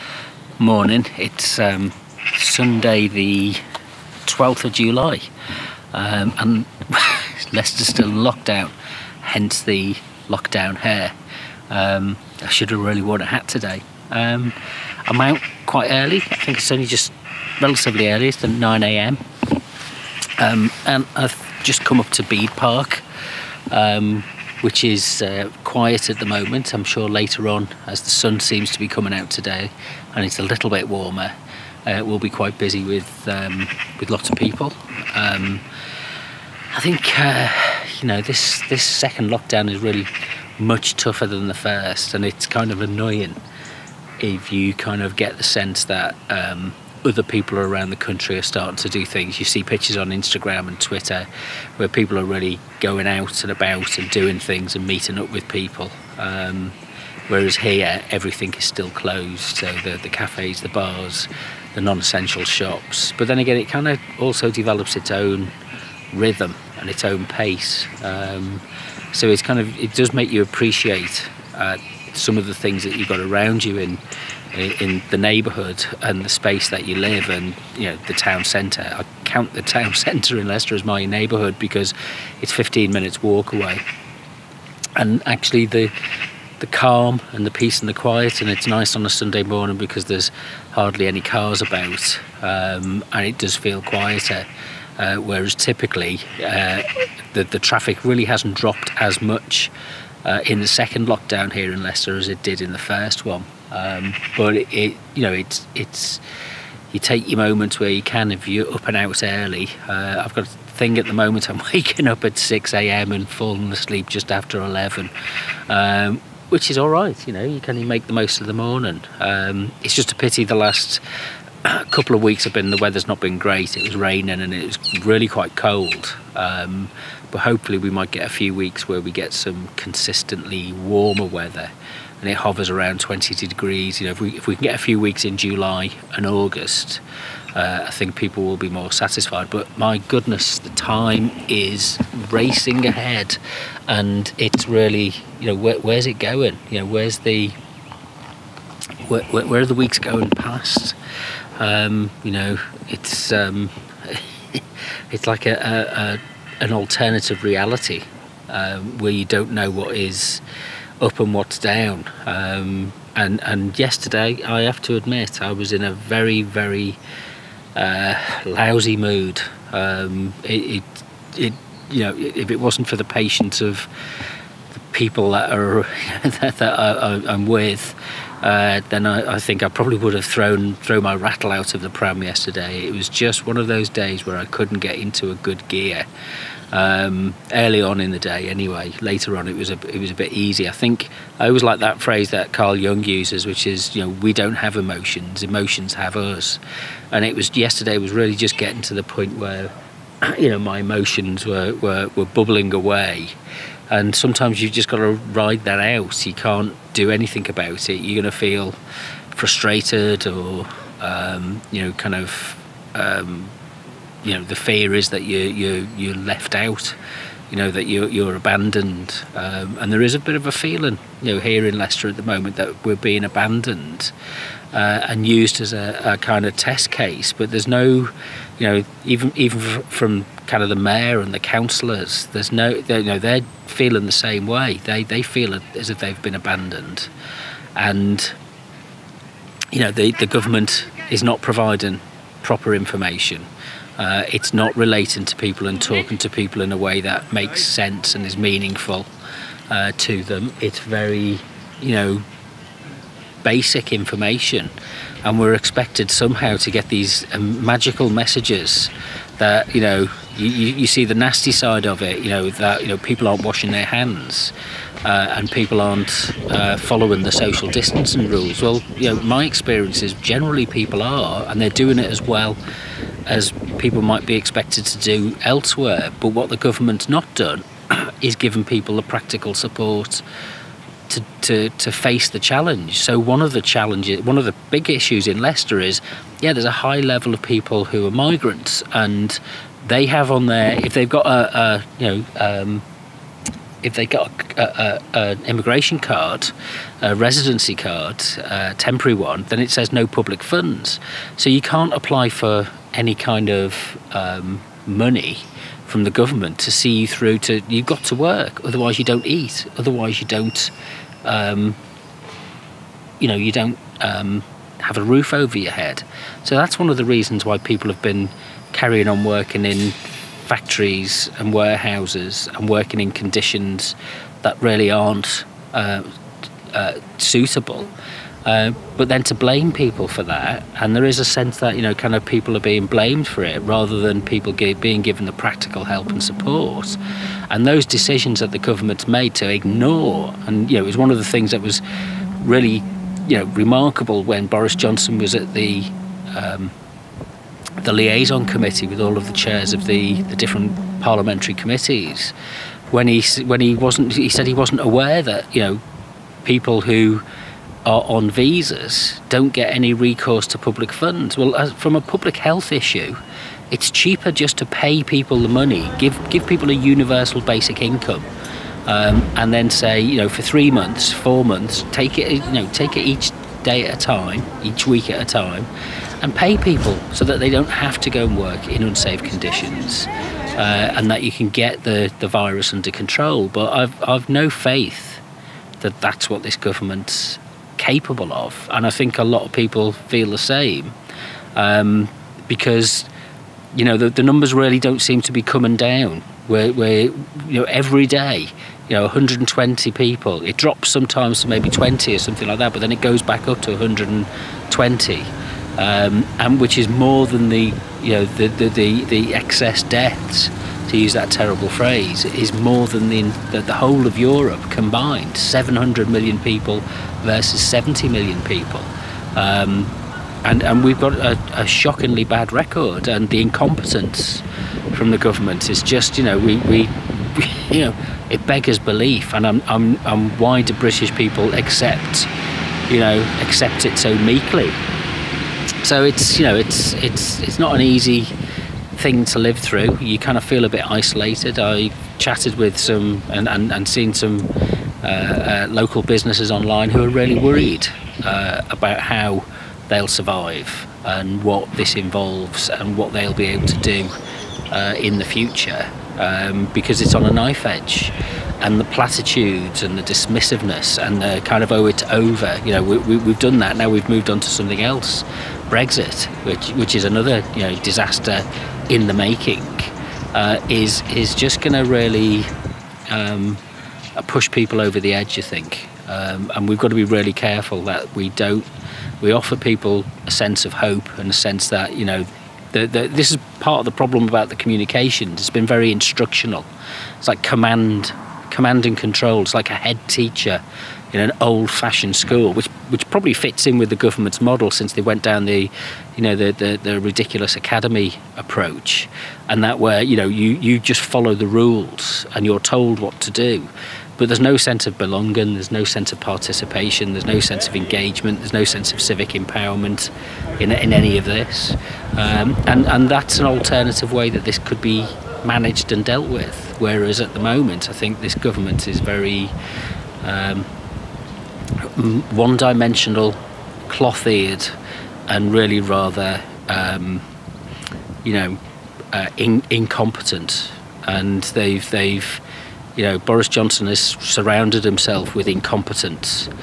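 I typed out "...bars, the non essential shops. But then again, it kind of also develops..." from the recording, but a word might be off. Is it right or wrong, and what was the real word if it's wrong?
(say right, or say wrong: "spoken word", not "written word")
right.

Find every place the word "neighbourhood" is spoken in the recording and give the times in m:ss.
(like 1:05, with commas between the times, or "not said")
1:15, 1:21.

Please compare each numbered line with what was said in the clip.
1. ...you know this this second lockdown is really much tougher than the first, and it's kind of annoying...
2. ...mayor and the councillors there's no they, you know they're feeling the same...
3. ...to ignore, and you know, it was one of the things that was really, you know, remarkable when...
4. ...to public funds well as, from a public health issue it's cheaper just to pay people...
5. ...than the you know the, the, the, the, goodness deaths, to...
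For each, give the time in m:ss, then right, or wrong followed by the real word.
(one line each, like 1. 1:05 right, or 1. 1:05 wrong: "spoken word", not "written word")
1. 0:37 right
2. 3:50 right
3. 5:39 right
4. 6:00 right
5. 6:47 wrong: "excess", not "goodness".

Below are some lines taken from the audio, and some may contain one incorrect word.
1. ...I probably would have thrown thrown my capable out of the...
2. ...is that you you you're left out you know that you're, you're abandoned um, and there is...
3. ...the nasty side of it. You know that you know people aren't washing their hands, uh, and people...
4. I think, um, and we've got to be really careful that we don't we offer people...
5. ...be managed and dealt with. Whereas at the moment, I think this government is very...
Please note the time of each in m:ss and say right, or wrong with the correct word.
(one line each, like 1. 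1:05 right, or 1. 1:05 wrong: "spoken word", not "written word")
1. 2:59 wrong: "rattle", not "capable"
2. 3:34 right
3. 4:21 right
4. 7:55 right
5. 8:34 right.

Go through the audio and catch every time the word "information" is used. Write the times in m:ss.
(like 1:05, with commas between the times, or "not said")
4:02, 4:13.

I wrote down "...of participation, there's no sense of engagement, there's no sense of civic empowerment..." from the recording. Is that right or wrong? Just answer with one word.
right.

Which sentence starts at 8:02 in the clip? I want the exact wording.
The, the, this is part of the problem about the communications.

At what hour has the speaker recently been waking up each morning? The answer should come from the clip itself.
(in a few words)
6 a.m.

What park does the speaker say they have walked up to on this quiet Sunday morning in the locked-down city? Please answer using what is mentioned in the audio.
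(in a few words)
Bede Park.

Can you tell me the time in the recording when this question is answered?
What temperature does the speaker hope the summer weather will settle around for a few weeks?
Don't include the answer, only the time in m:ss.
2:12.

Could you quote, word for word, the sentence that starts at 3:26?
You can't do anything about it.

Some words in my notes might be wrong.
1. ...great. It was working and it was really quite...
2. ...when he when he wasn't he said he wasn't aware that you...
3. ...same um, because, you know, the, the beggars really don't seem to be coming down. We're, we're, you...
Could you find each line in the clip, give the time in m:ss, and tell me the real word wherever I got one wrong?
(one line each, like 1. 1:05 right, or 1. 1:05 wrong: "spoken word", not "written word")
1. 2:03 wrong: "raining", not "working"
2. 5:52 right
3. 6:30 wrong: "numbers", not "beggars".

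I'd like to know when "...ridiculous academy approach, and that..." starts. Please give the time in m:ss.
8:16.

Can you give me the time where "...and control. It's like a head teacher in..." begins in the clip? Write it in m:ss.
8:08.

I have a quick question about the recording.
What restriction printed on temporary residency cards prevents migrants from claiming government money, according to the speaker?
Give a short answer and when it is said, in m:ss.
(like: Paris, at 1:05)
No public funds, at 4:59.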